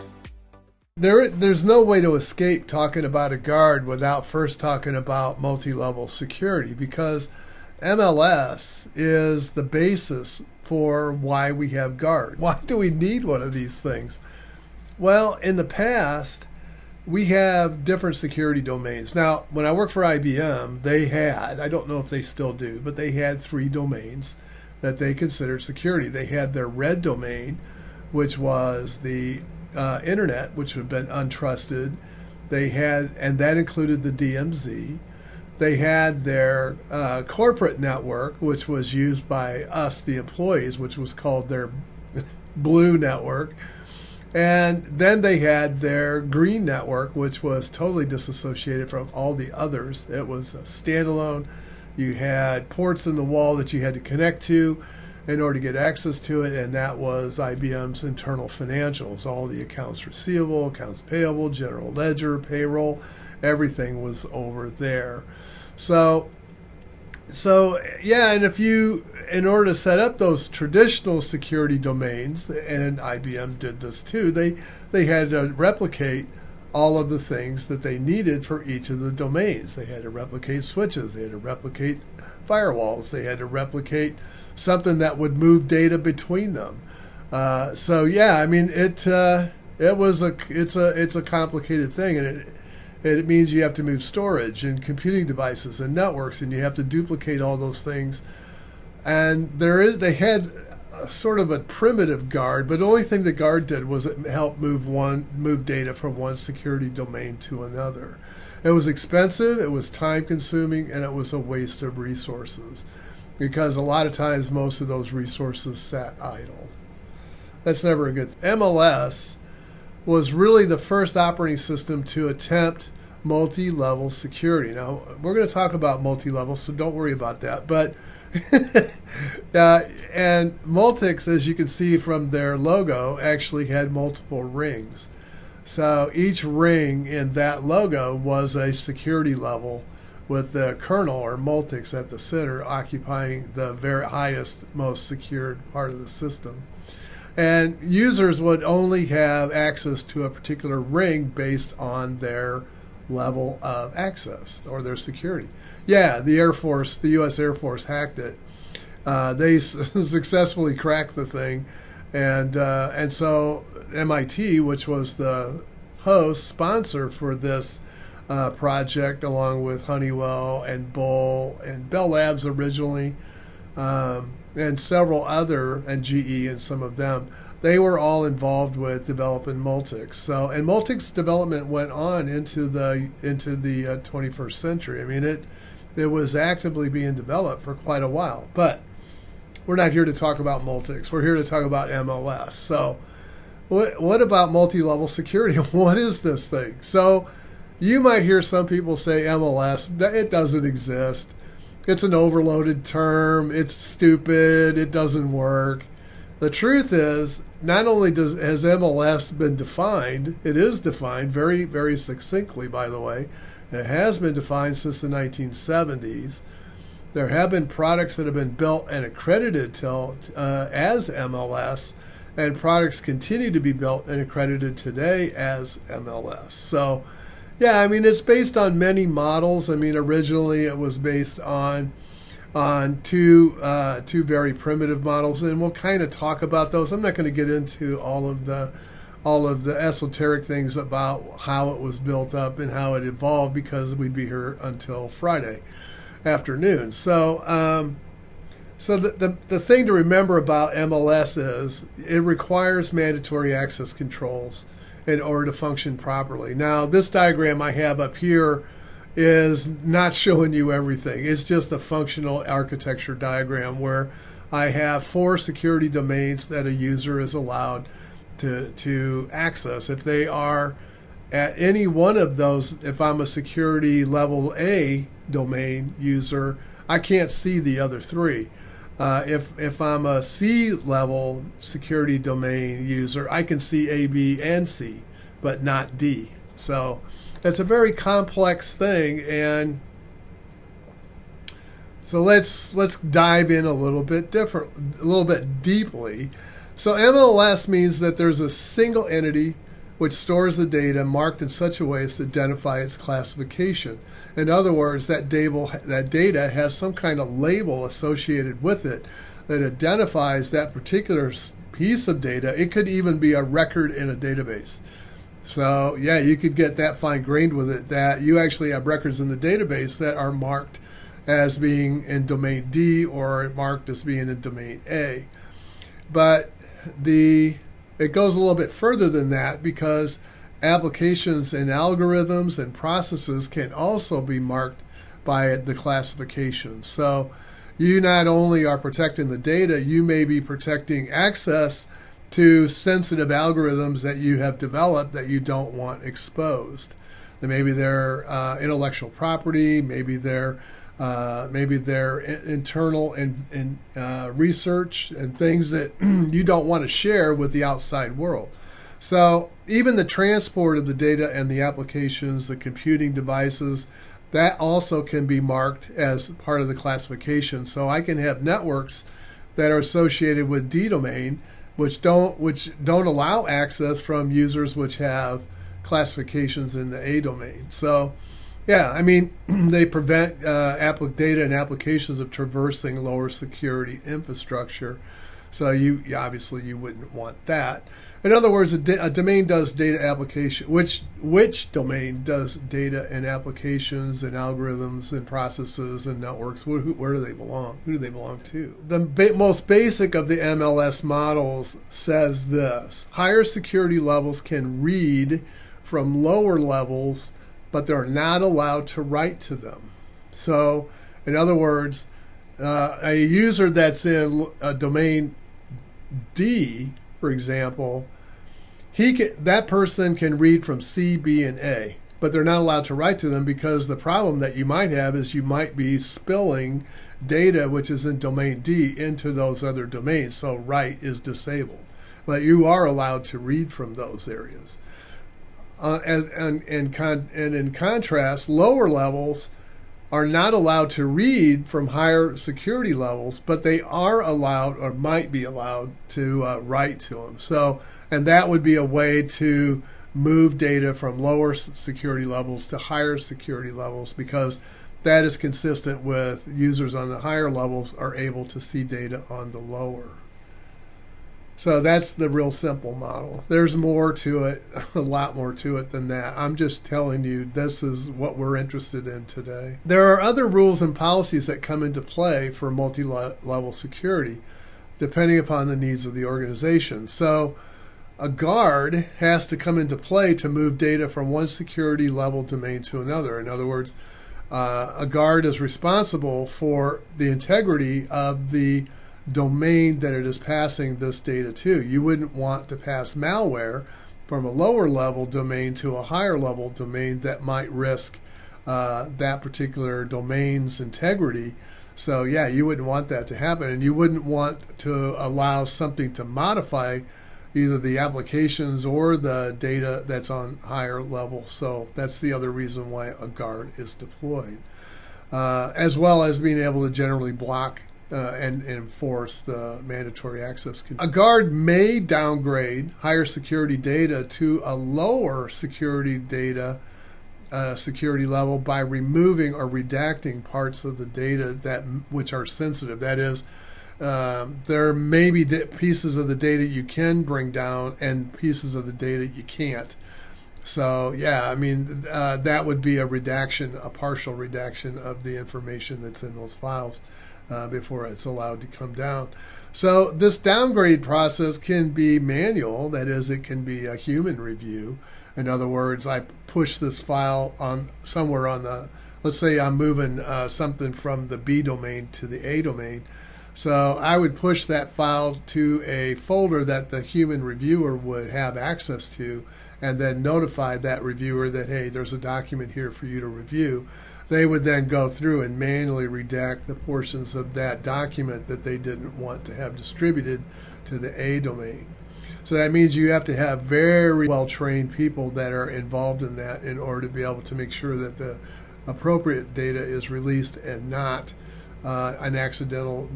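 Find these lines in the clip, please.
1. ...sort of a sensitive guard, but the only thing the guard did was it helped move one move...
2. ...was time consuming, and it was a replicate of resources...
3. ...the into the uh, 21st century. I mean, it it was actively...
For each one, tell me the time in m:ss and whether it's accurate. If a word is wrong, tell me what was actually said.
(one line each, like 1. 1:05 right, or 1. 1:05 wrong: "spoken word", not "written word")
1. 1:41 wrong: "primitive", not "sensitive"
2. 1:49 wrong: "waste", not "replicate"
3. 3:02 right.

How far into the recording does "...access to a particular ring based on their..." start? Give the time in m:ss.
2:29.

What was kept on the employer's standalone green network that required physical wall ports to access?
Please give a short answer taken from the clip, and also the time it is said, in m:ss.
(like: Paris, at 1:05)
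internal financials, at 0:58.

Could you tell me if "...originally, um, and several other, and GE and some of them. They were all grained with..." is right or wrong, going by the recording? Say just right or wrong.
wrong.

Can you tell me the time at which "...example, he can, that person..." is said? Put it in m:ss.
6:57.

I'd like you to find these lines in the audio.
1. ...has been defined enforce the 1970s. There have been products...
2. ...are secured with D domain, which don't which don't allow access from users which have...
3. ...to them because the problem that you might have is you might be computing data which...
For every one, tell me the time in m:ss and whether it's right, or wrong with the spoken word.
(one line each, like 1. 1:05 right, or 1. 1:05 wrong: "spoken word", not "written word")
1. 3:33 wrong: "since", not "enforce"
2. 6:09 wrong: "associated", not "secured"
3. 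7:03 wrong: "spilling", not "computing".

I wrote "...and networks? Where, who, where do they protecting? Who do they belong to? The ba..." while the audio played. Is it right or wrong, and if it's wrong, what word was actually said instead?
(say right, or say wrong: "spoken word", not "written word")
wrong: "belong", not "protecting".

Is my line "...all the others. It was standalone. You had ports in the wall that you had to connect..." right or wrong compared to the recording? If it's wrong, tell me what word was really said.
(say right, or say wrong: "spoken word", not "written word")
right.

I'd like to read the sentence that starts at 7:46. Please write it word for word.
I'm just telling you, this is what we're interested in today.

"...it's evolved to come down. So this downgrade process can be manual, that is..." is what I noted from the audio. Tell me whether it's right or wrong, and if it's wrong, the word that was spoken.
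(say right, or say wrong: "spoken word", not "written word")
wrong: "allowed", not "evolved".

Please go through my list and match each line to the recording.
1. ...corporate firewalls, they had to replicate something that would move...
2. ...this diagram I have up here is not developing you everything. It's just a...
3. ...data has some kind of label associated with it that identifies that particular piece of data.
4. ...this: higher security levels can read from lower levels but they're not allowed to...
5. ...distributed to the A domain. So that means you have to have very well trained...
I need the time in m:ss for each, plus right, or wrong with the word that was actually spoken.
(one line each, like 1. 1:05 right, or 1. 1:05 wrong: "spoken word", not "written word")
1. 1:21 wrong: "replicate", not "corporate"
2. 4:16 wrong: "showing", not "developing"
3. 5:05 right
4. 6:42 right
5. 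9:39 right.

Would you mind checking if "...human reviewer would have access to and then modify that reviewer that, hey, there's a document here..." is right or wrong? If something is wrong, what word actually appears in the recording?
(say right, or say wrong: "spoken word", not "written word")
wrong: "notify", not "modify".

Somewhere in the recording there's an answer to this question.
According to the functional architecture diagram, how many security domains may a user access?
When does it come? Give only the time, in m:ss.
4:25.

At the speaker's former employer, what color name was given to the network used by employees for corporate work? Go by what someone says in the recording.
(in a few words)
blue network.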